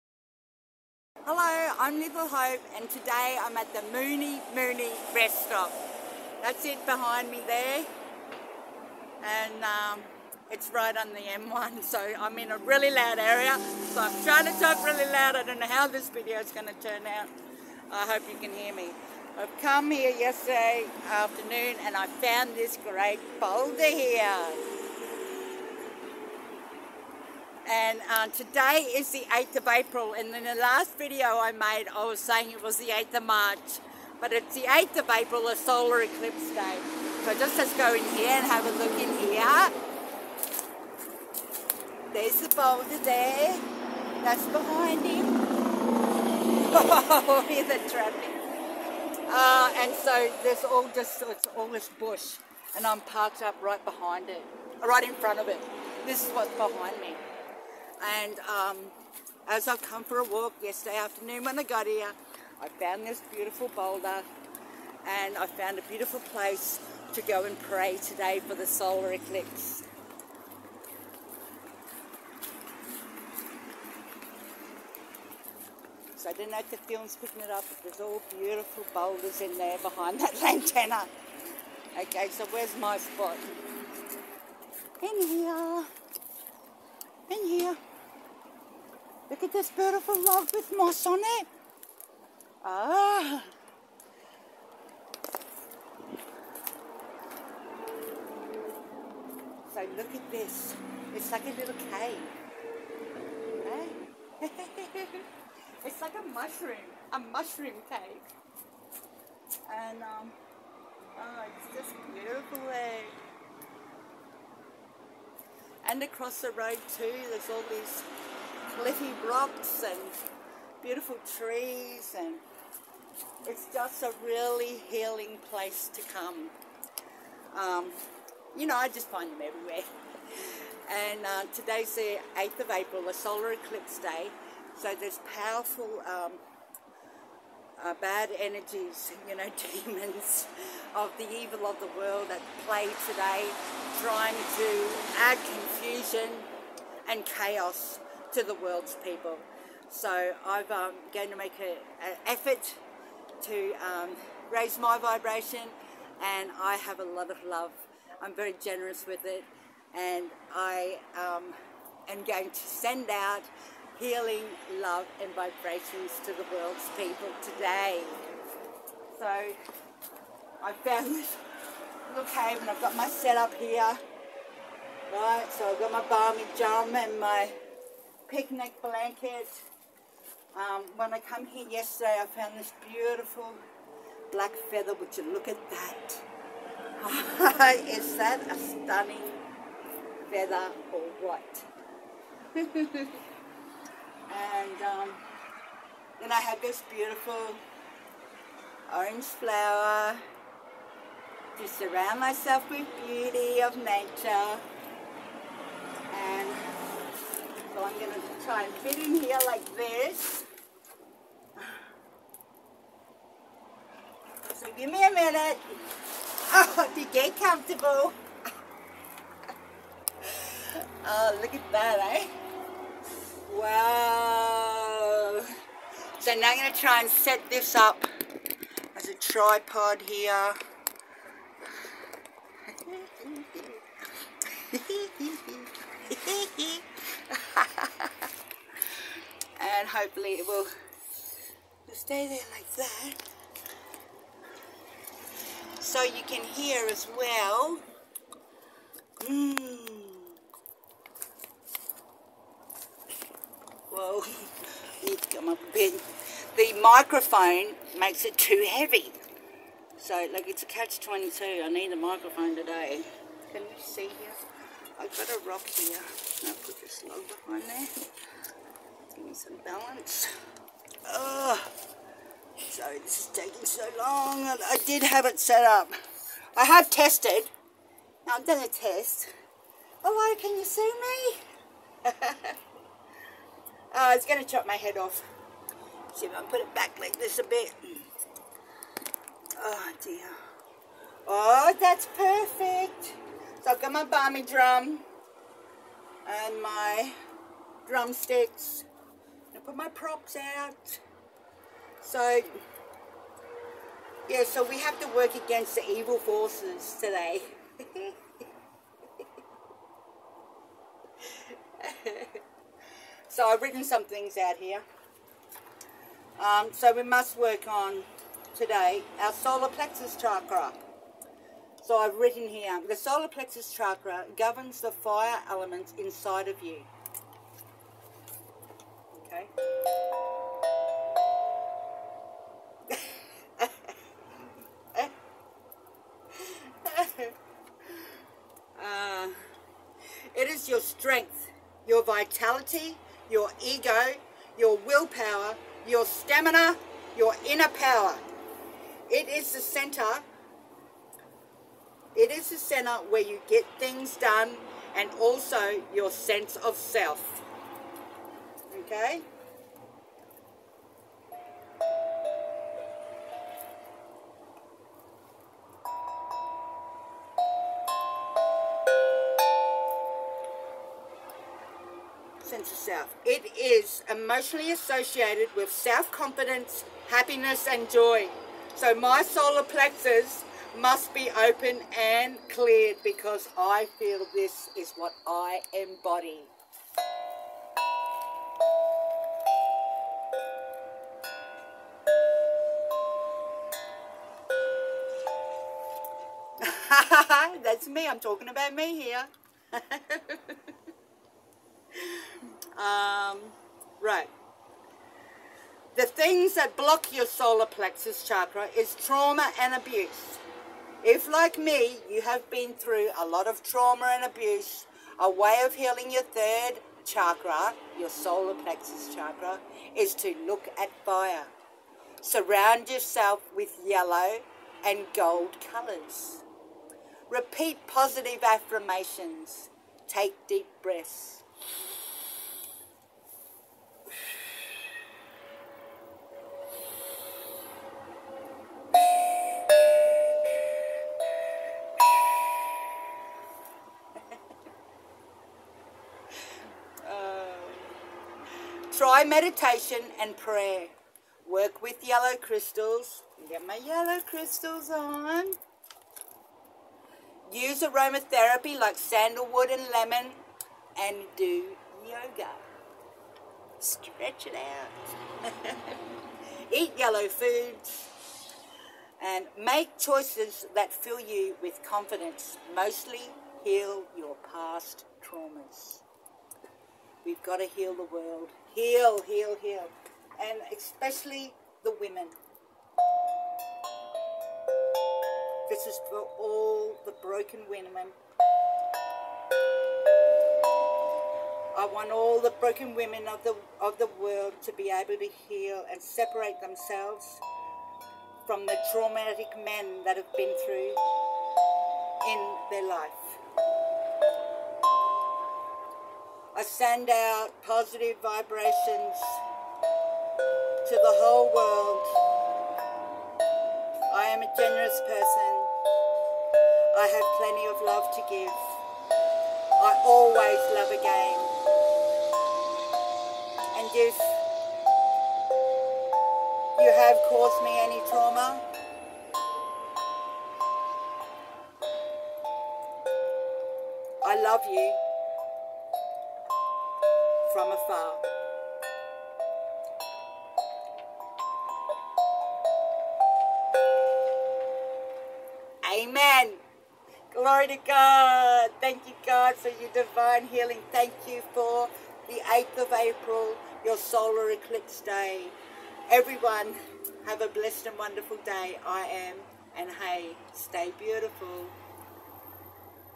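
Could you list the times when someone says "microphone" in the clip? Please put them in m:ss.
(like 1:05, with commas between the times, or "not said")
4:16, 4:21.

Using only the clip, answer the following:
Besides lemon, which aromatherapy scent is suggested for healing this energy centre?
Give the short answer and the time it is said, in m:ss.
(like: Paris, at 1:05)
sandalwood, at 7:38.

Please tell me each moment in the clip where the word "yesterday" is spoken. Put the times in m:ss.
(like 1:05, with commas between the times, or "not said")
0:20, 1:00, 3:01.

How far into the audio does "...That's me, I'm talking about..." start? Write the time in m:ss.
6:37.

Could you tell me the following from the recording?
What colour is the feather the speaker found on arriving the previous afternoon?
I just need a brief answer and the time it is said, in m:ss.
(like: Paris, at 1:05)
black, at 3:04.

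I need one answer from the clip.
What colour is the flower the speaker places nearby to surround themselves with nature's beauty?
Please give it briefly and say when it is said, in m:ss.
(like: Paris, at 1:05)
orange, at 3:18.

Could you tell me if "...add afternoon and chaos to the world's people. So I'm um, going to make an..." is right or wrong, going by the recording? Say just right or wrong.
wrong.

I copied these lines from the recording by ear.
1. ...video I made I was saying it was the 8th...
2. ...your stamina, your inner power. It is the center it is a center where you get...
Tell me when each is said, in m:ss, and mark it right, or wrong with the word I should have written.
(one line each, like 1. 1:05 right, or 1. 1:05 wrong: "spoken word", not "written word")
1. 0:30 right
2. 5:45 right.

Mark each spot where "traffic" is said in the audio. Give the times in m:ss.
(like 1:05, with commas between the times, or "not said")
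0:47.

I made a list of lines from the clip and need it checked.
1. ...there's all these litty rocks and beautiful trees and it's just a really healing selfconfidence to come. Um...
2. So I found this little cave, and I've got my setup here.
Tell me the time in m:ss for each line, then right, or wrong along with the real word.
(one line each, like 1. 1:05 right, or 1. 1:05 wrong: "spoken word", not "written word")
1. 1:57 wrong: "place", not "selfconfidence"
2. 2:49 right.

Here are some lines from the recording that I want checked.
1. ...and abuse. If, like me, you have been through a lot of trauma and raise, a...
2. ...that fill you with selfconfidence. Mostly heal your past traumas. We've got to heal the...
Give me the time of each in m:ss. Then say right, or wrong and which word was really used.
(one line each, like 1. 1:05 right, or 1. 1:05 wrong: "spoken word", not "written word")
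1. 6:49 wrong: "abuse", not "raise"
2. 7:50 wrong: "confidence", not "selfconfidence".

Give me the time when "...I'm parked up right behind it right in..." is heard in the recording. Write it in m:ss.
0:52.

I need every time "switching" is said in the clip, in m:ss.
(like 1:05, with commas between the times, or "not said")
not said.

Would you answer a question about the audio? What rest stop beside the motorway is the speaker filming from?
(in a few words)
Mooney Mooney.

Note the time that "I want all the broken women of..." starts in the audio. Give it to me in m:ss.
8:11.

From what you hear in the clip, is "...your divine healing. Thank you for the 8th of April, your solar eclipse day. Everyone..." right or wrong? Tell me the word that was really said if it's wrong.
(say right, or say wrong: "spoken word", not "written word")
right.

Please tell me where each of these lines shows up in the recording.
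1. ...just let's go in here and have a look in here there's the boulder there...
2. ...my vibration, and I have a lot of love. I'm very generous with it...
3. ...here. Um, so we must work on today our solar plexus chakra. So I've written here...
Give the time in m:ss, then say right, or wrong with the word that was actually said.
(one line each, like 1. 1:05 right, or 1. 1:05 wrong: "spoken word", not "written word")
1. 0:37 right
2. 2:34 right
3. 5:14 right.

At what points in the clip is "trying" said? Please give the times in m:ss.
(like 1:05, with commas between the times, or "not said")
0:14, 2:24.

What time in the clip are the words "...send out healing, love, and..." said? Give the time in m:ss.
2:42.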